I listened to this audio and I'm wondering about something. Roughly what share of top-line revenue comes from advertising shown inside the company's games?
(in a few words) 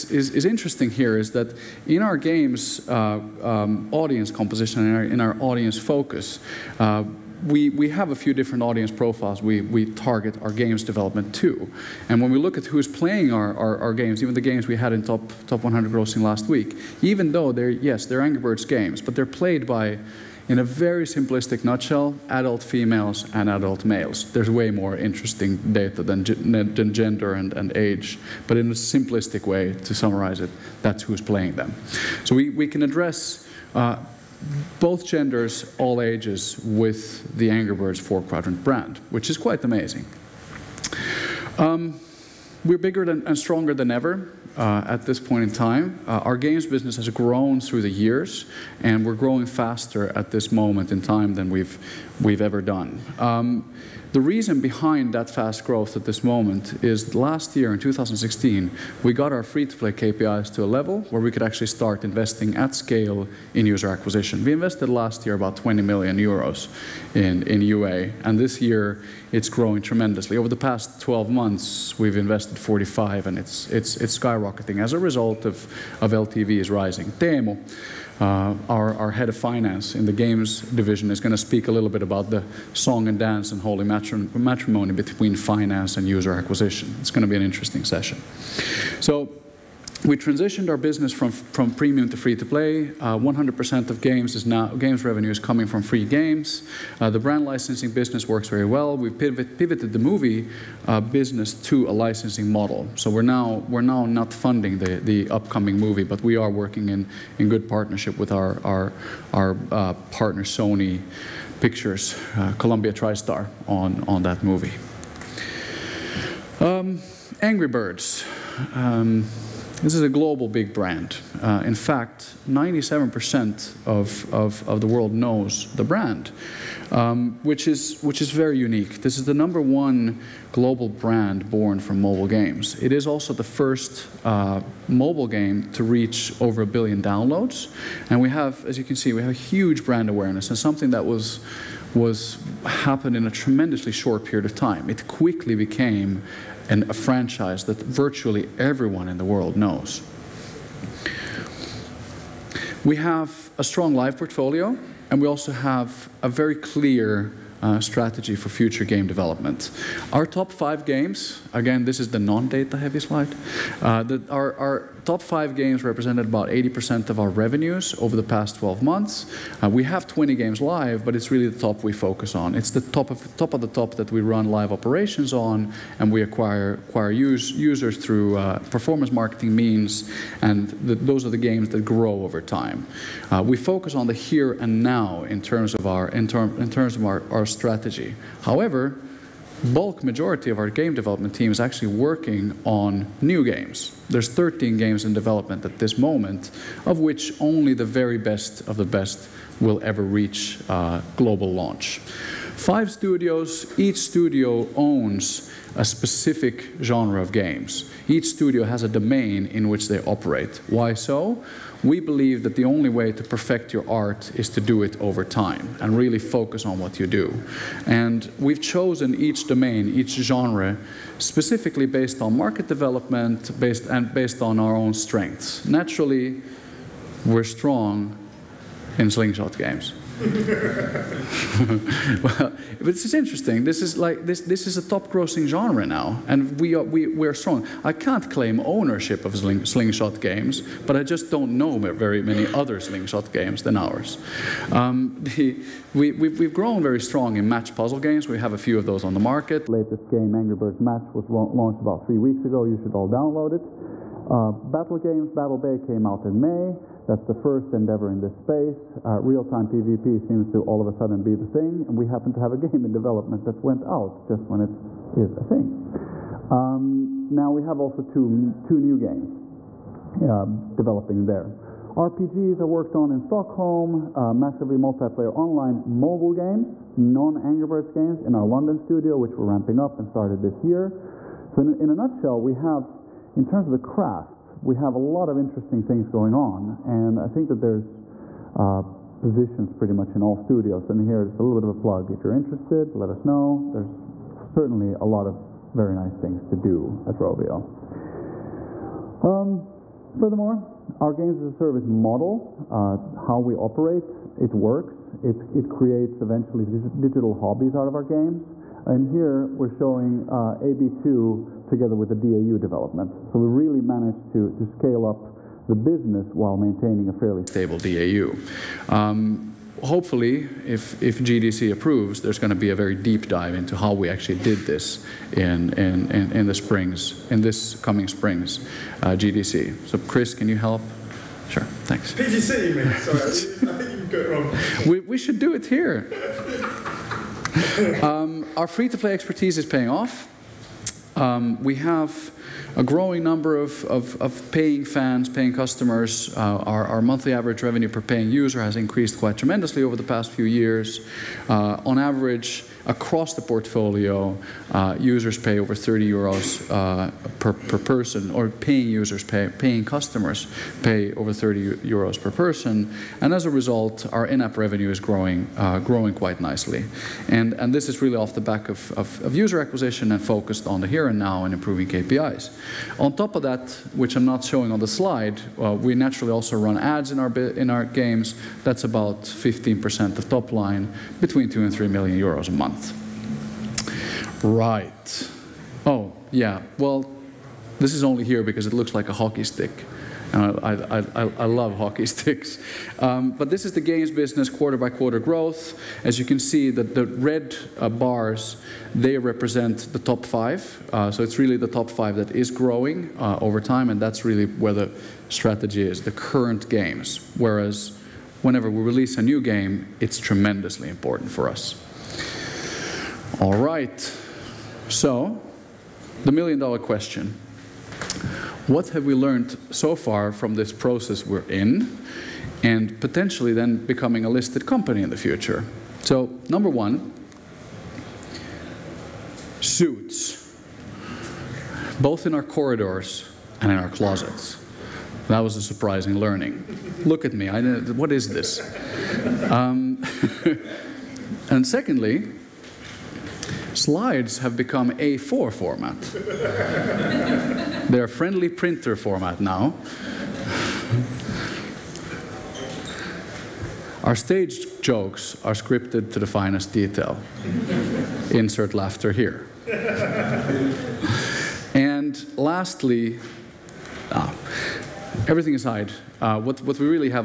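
15%.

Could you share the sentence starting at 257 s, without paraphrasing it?
That's the first endeavor in this space.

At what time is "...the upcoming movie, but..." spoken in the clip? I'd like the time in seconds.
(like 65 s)
104 s.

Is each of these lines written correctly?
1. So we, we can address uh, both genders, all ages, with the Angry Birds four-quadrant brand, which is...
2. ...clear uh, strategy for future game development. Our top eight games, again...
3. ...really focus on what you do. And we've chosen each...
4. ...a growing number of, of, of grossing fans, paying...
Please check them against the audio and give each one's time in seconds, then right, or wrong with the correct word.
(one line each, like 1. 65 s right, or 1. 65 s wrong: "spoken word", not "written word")
1. 32 s right
2. 156 s wrong: "five", not "eight"
3. 215 s right
4. 342 s wrong: "paying", not "grossing".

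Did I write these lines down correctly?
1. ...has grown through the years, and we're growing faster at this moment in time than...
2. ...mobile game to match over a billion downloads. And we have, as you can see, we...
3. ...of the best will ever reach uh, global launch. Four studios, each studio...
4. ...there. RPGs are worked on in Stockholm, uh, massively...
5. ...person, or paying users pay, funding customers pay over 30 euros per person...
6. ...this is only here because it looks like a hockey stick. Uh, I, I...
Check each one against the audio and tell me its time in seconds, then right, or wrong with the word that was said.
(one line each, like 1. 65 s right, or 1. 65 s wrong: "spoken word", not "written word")
1. 46 s right
2. 134 s wrong: "reach", not "match"
3. 198 s wrong: "Five", not "Four"
4. 271 s right
5. 357 s wrong: "paying", not "funding"
6. 387 s right.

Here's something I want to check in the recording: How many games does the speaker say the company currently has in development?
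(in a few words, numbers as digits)
13.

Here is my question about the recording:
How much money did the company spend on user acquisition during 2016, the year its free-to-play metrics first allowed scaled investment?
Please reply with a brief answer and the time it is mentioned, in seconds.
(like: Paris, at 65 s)
20 million euros, at 65 s.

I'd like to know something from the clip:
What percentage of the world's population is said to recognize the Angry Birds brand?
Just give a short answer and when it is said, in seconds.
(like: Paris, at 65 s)
97%, at 122 s.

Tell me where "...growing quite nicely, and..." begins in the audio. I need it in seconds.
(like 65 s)
365 s.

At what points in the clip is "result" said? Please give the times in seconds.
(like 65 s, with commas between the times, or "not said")
74 s, 363 s.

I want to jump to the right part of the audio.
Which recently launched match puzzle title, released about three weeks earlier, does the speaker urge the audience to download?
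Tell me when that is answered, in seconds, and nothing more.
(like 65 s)
250 s.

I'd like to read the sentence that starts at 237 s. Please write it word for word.
I can't claim ownership of sling, slingshot games, but I just don't know very many other slingshot games than ours.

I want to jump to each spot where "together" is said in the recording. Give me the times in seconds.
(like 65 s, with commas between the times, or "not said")
311 s.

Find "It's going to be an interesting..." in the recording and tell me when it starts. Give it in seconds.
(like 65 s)
87 s.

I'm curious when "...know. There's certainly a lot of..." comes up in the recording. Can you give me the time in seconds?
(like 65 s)
293 s.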